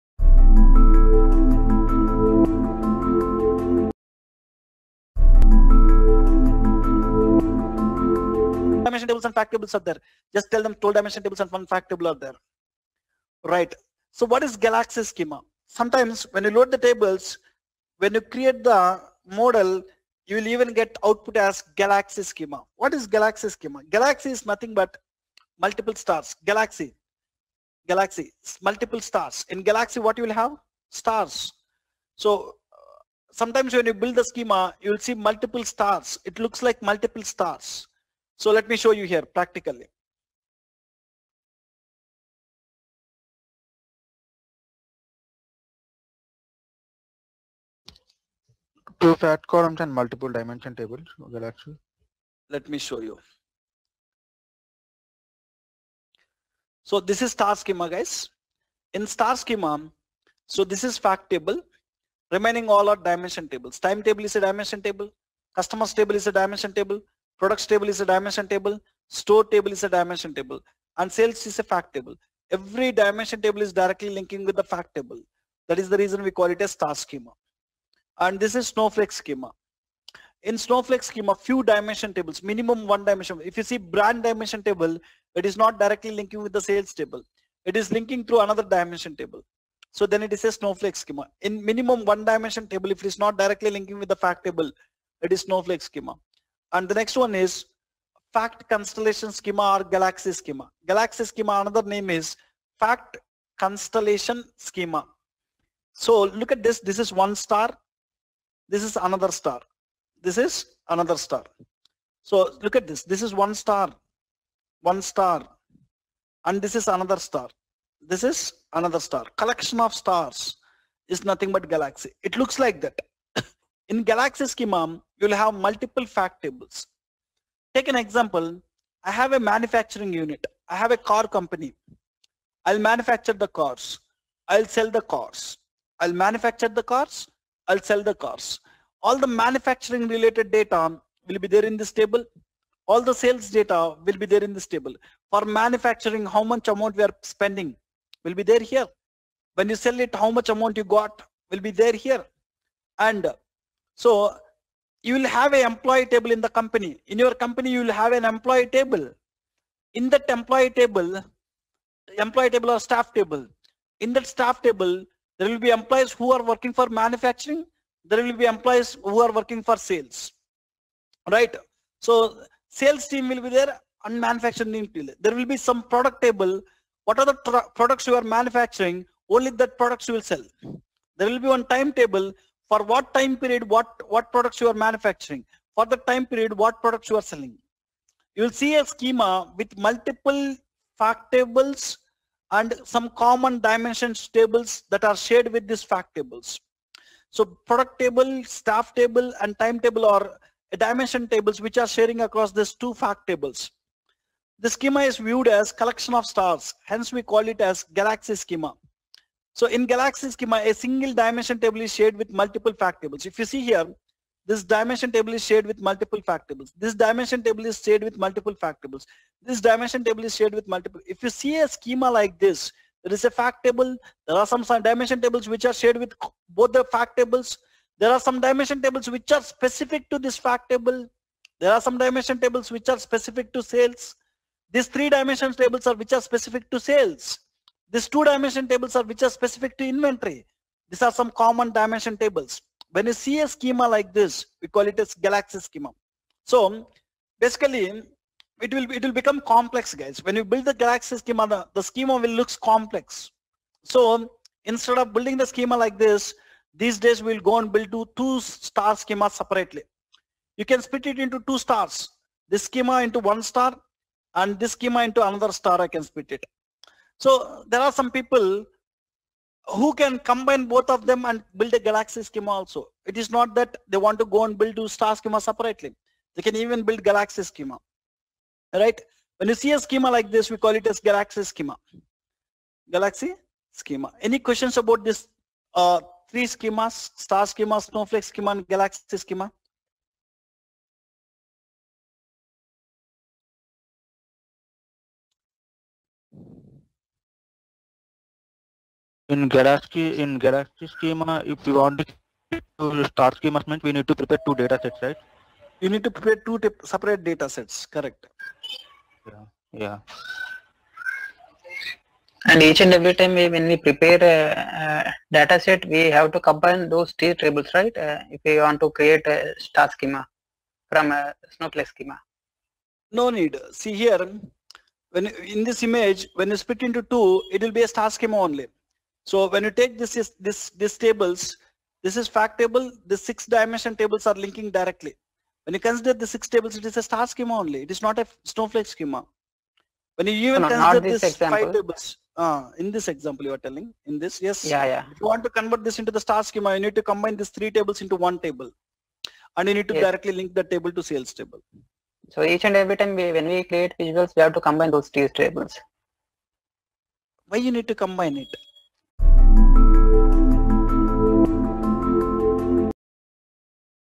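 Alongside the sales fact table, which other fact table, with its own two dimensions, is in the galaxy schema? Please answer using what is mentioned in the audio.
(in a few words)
Inventory.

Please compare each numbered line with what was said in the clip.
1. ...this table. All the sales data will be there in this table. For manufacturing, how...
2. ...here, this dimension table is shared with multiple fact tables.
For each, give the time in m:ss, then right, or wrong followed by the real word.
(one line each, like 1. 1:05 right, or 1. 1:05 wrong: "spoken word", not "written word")
1. 2:21 right
2. 3:33 right.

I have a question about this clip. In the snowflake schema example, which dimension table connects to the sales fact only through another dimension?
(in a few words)
Brand.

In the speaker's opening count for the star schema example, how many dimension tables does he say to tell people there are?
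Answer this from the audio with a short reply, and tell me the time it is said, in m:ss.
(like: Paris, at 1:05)
12, at 0:10.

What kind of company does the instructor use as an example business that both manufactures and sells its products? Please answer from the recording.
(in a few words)
A car company.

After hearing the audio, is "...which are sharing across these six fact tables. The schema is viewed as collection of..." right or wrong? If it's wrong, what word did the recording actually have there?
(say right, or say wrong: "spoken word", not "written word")
wrong: "two", not "six".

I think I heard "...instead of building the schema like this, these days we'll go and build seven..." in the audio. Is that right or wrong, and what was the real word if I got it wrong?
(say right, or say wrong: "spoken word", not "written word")
wrong: "two", not "seven".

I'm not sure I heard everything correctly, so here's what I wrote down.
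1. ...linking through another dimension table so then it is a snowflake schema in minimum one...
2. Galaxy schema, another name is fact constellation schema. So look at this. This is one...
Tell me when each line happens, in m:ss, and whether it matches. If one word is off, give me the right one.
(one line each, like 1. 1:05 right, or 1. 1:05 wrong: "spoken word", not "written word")
1. 1:27 right
2. 1:40 right.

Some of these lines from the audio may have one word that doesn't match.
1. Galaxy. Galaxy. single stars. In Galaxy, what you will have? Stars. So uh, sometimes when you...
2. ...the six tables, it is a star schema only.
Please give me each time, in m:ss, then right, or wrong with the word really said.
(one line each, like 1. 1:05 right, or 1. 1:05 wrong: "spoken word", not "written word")
1. 0:26 wrong: "multiple", not "single"
2. 5:36 right.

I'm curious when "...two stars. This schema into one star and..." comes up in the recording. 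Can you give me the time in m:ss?
4:21.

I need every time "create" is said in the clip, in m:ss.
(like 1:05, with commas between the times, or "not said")
0:18, 5:18, 5:53.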